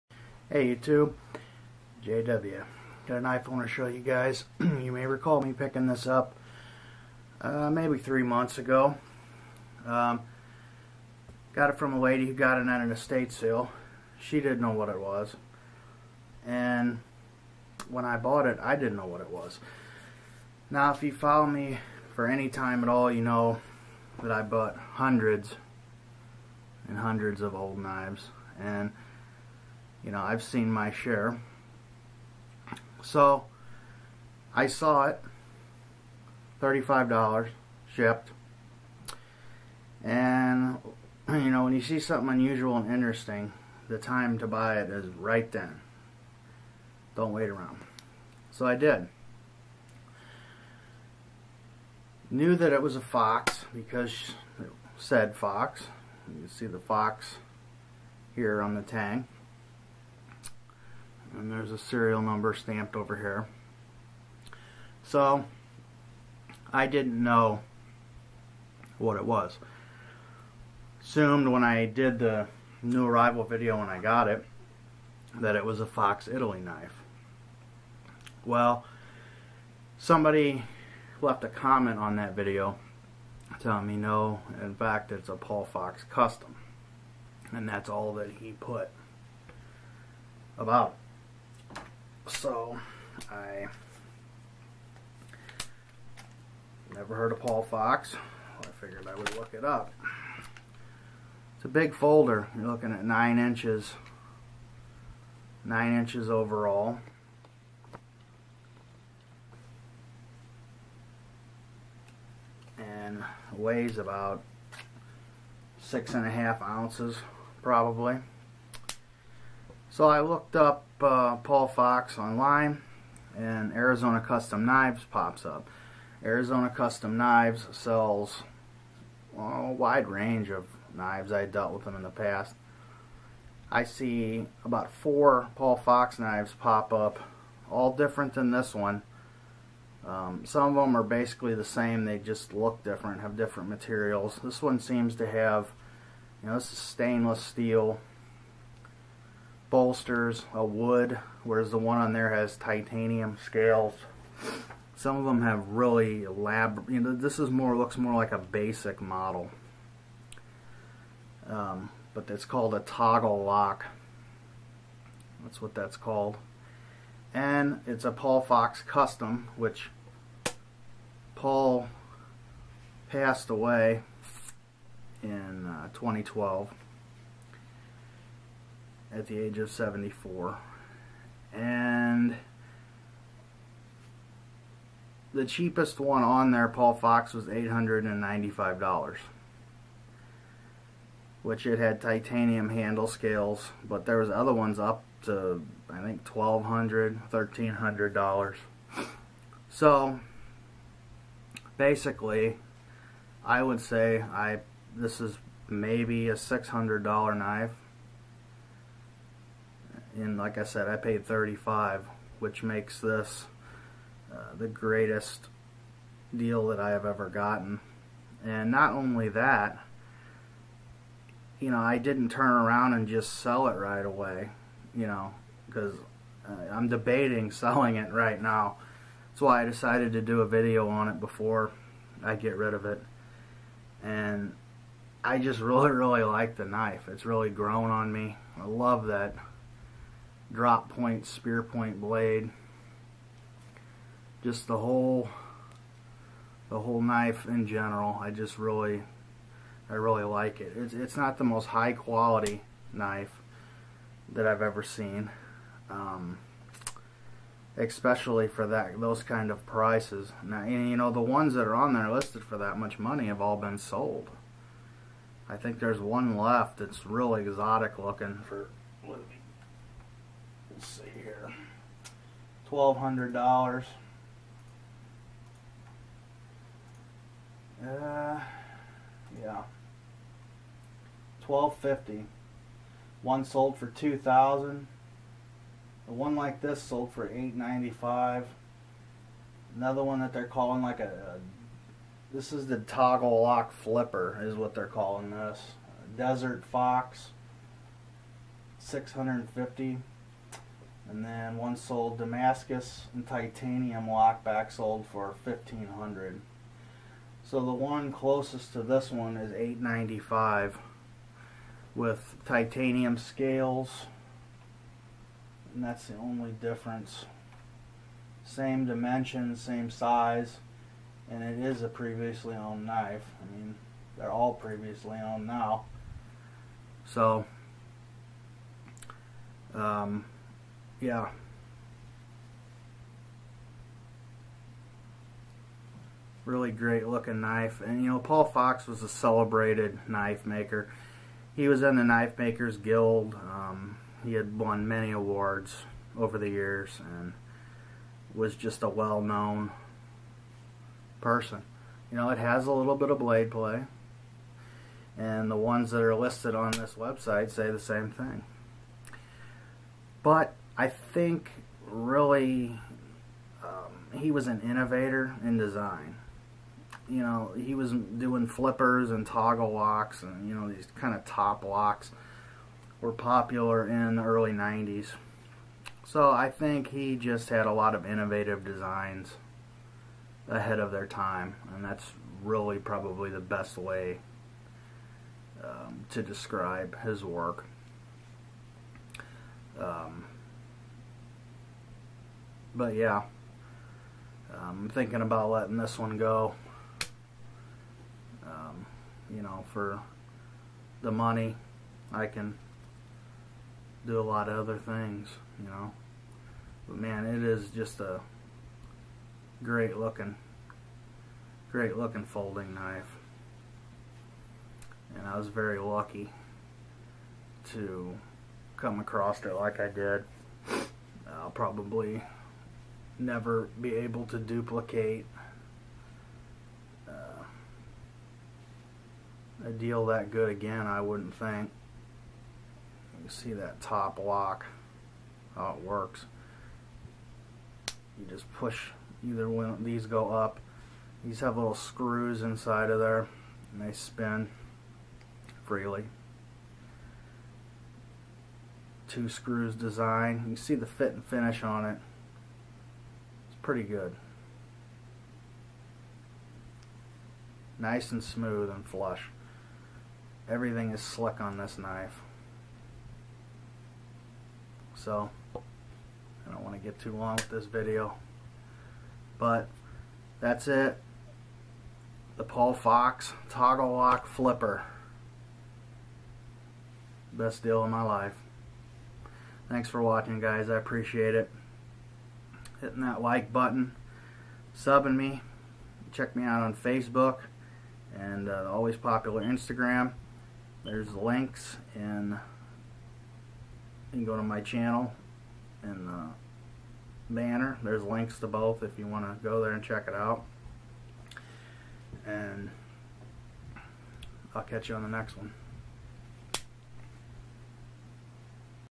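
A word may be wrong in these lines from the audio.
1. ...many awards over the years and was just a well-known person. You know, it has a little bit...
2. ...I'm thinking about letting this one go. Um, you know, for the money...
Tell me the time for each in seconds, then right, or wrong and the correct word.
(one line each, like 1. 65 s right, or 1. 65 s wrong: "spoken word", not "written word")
1. 344 s right
2. 394 s right.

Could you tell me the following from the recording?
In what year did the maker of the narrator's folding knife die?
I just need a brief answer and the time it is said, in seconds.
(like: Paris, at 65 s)
2012, at 175 s.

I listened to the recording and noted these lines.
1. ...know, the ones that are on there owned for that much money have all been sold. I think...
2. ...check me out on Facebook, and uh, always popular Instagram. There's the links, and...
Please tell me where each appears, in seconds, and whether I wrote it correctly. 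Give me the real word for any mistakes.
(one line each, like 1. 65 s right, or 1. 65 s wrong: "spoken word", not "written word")
1. 260 s wrong: "listed", not "owned"
2. 486 s right.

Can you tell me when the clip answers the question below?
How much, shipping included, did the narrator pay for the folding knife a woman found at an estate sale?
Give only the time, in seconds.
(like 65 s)
36 s.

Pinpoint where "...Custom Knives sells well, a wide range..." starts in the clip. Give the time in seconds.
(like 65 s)
126 s.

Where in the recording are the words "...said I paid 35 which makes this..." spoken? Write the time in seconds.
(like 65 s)
210 s.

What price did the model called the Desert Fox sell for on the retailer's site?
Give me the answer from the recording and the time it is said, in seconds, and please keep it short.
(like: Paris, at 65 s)
650, at 296 s.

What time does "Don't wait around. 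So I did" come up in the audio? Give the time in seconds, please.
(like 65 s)
47 s.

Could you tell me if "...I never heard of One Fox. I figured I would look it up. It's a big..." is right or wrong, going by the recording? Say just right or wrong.
wrong.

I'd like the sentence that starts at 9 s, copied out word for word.
Um, got it from a lady who got it at an estate sale.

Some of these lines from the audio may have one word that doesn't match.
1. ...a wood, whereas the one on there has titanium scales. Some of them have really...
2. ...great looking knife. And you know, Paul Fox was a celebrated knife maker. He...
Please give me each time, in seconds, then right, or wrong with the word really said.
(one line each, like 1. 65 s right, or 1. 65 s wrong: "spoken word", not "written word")
1. 150 s right
2. 336 s right.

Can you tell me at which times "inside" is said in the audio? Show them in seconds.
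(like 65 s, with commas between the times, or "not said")
442 s.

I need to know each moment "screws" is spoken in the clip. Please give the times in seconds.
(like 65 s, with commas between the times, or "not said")
441 s, 449 s.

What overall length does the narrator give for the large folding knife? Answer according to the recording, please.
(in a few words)
9 inches.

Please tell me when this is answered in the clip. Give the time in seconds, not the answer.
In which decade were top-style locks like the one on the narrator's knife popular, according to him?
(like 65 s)
374 s.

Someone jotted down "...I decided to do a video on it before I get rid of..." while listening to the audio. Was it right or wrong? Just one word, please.
right.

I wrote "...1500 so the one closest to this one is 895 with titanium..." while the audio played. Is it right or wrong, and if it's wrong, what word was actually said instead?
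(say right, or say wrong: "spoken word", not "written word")
right.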